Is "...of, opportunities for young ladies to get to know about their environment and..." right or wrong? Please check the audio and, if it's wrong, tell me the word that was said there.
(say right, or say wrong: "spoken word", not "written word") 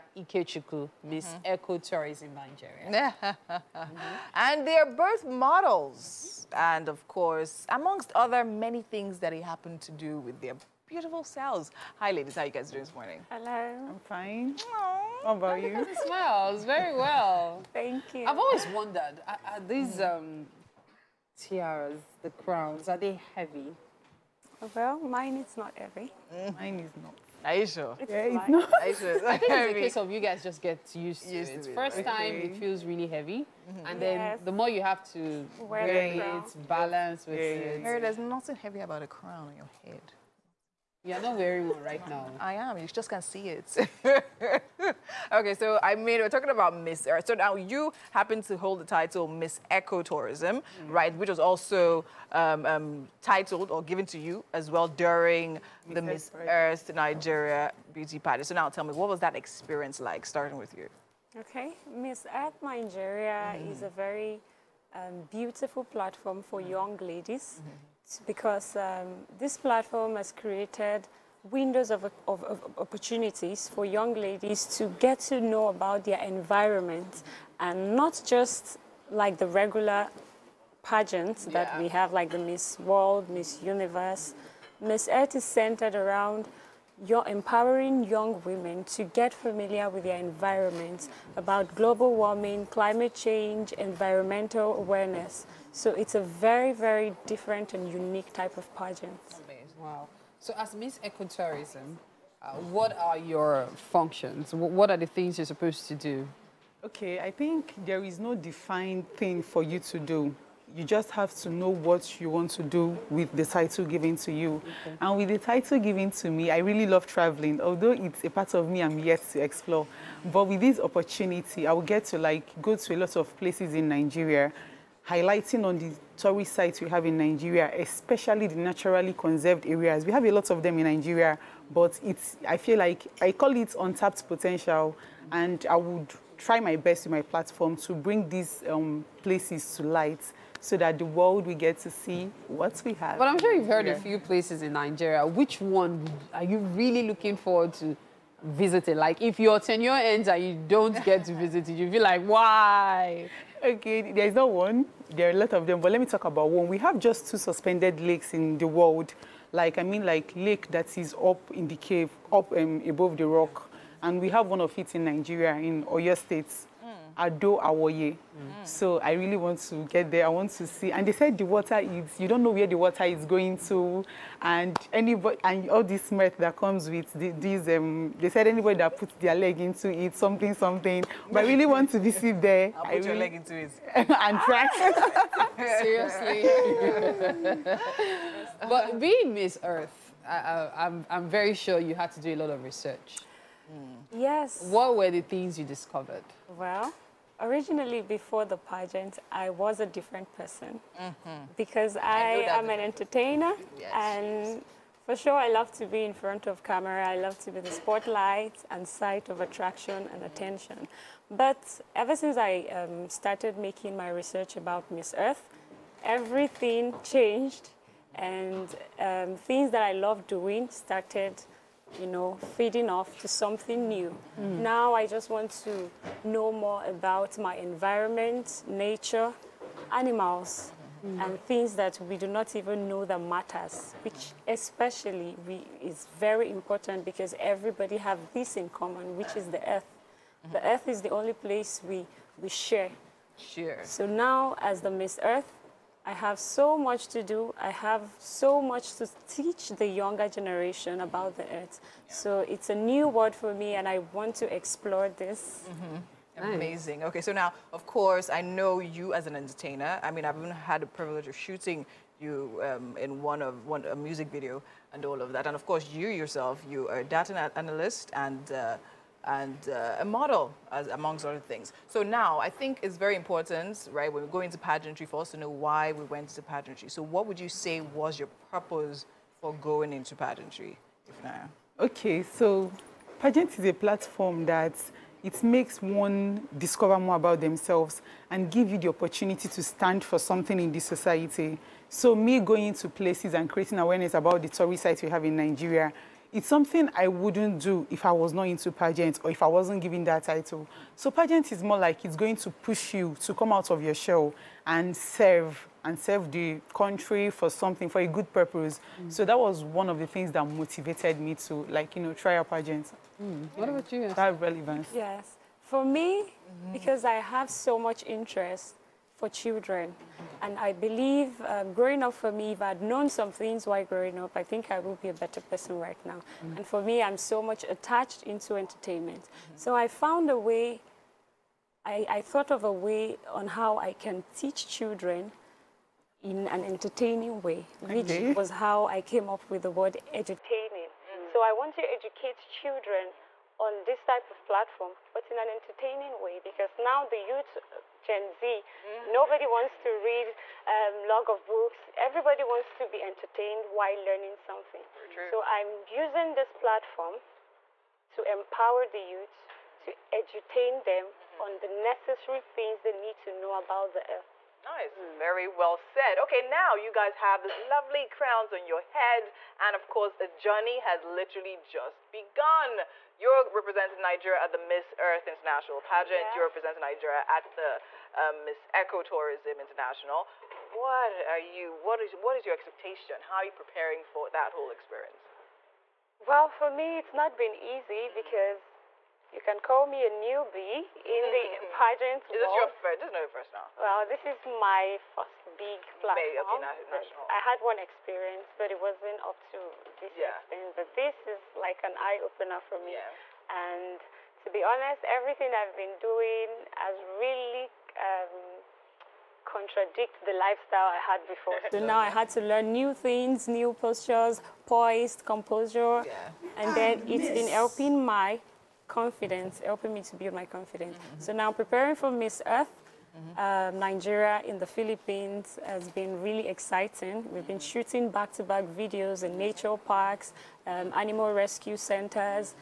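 right.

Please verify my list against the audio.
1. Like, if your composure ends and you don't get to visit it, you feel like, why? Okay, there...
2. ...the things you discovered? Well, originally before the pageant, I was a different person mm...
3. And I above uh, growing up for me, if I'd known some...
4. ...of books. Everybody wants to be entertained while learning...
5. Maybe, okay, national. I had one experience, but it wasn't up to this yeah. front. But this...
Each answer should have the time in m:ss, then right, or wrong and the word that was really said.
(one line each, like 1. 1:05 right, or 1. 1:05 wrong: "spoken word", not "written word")
1. 2:28 wrong: "tenure", not "composure"
2. 3:15 right
3. 5:20 wrong: "believe", not "above"
4. 5:51 right
5. 6:36 wrong: "extent", not "front".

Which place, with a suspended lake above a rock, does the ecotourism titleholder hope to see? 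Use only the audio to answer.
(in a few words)
Ado Awaye.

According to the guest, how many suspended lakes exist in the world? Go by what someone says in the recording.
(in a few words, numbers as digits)
2.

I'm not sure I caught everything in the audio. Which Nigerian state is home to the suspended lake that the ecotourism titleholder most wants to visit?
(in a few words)
Oyo State.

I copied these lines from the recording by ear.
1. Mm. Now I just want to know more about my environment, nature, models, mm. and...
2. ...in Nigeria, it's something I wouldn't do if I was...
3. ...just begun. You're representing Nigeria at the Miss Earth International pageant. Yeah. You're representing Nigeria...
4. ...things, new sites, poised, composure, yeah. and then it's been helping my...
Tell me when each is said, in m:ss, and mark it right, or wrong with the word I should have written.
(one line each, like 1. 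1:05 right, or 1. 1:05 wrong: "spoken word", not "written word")
1. 3:44 wrong: "animals", not "models"
2. 4:55 right
3. 6:11 right
4. 6:52 wrong: "postures", not "sites".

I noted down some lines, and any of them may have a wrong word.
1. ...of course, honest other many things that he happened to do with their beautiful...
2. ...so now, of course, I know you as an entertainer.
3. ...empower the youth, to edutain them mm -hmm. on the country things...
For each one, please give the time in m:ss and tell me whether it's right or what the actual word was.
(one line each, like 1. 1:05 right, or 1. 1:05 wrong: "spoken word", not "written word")
1. 0:06 wrong: "amongst", not "honest"
2. 4:17 right
3. 5:58 wrong: "necessary", not "country".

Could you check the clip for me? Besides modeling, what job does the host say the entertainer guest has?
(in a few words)
Data analyst.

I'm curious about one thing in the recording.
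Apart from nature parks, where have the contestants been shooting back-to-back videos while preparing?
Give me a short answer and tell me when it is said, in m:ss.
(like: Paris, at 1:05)
Animal rescue centers, at 7:11.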